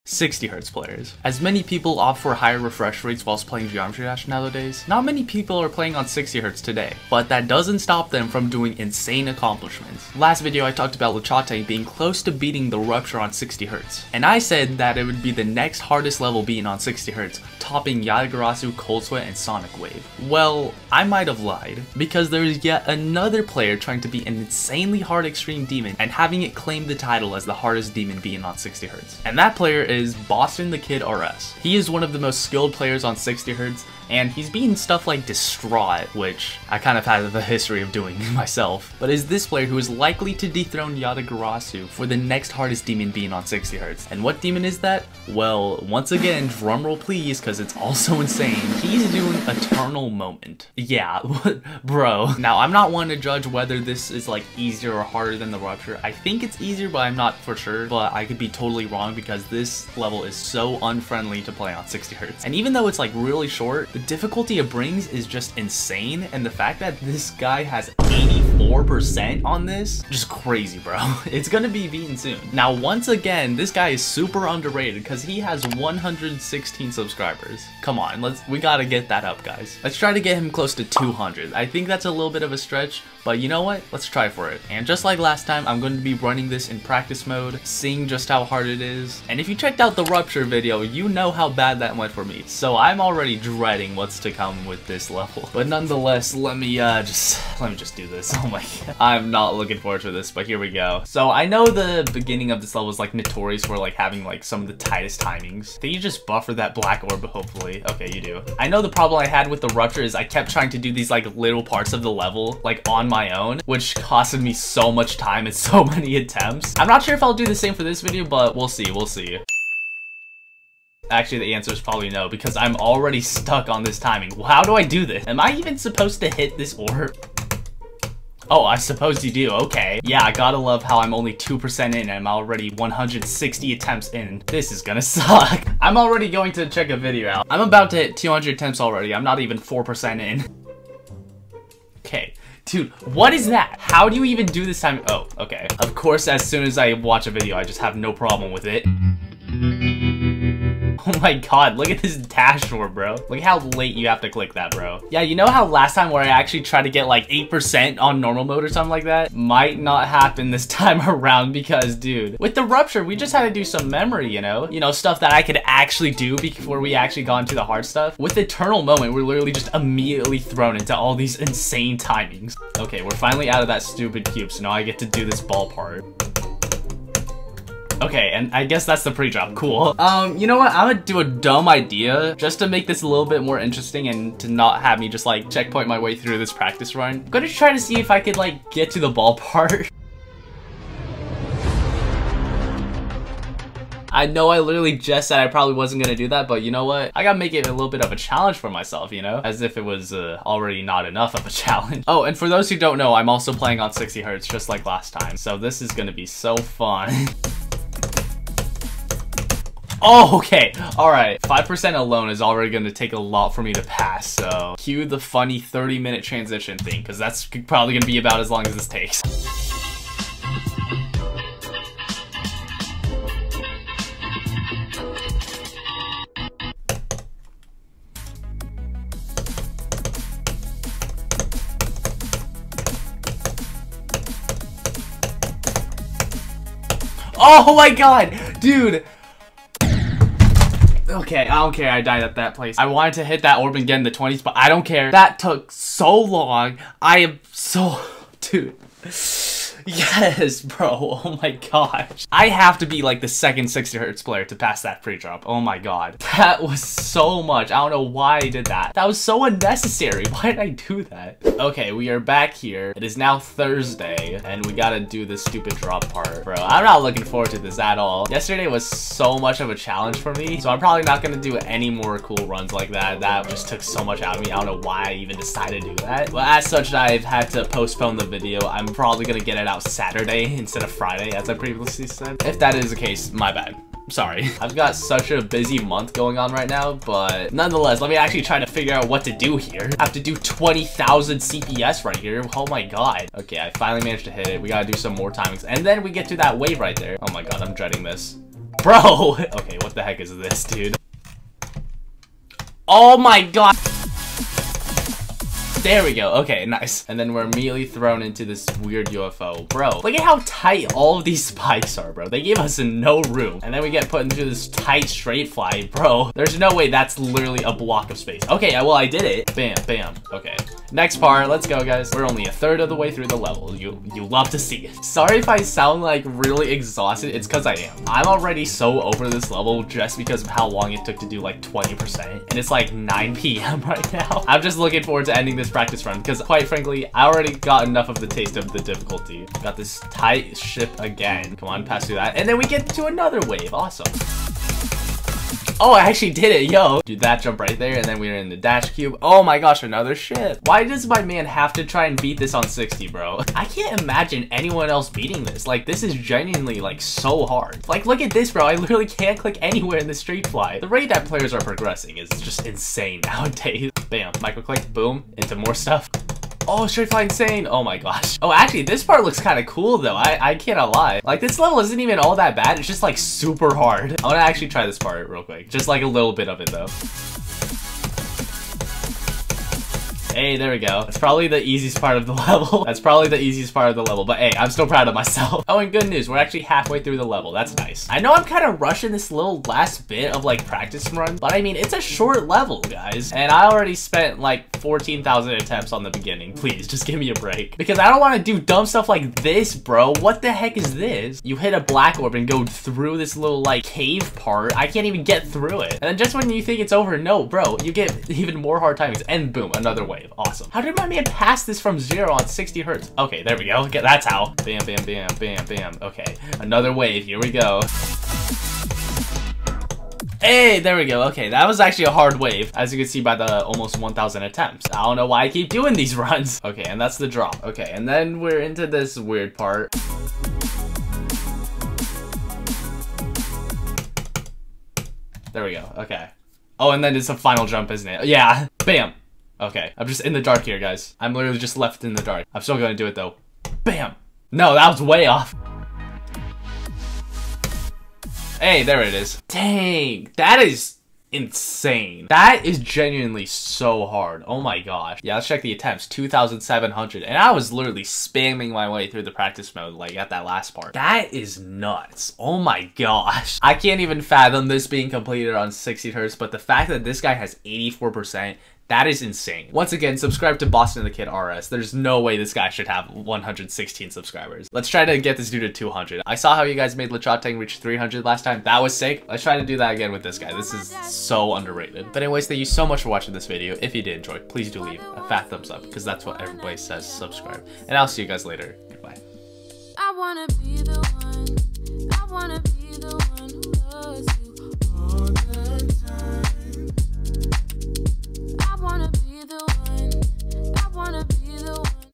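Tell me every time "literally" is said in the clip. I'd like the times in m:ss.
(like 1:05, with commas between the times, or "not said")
2:49, 3:14, 5:17, 5:58, 7:21, 7:37.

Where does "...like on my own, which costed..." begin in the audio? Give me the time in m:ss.
1:52.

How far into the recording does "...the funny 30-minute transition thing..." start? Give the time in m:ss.
3:35.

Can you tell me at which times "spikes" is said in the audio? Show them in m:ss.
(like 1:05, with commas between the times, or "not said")
5:11.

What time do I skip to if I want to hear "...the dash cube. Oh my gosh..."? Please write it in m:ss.
5:48.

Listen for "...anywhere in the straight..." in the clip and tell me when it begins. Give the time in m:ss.
5:59.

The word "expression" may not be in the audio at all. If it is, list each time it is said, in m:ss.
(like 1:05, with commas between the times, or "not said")
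not said.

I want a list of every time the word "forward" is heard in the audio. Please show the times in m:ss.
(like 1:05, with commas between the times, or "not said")
1:39, 4:27, 5:35.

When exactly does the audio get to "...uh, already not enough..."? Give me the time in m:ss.
3:20.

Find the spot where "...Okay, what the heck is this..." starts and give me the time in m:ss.
4:59.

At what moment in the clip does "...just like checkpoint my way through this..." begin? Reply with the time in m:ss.
3:05.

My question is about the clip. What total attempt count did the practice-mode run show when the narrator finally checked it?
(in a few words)
2,700.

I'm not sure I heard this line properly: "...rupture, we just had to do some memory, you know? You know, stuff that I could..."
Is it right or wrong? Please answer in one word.
right.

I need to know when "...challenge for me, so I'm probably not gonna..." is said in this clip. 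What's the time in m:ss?
4:29.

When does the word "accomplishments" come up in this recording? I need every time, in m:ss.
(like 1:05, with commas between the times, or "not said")
0:09.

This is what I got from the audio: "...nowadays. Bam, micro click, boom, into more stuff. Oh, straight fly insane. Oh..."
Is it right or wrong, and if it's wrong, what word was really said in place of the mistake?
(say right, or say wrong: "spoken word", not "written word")
right.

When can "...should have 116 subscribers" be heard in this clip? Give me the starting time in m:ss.
7:52.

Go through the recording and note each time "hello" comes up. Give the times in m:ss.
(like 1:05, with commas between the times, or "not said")
not said.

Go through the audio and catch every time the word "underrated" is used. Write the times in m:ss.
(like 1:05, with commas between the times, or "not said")
1:14, 8:01.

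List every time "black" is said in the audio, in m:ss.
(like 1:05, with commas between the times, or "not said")
1:46, 6:41.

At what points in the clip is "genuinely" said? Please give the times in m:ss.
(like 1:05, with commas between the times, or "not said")
5:56, 7:32.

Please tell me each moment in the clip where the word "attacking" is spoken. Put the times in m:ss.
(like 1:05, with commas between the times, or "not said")
not said.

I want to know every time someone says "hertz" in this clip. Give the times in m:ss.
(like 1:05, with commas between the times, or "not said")
3:24, 4:13, 6:52, 7:46.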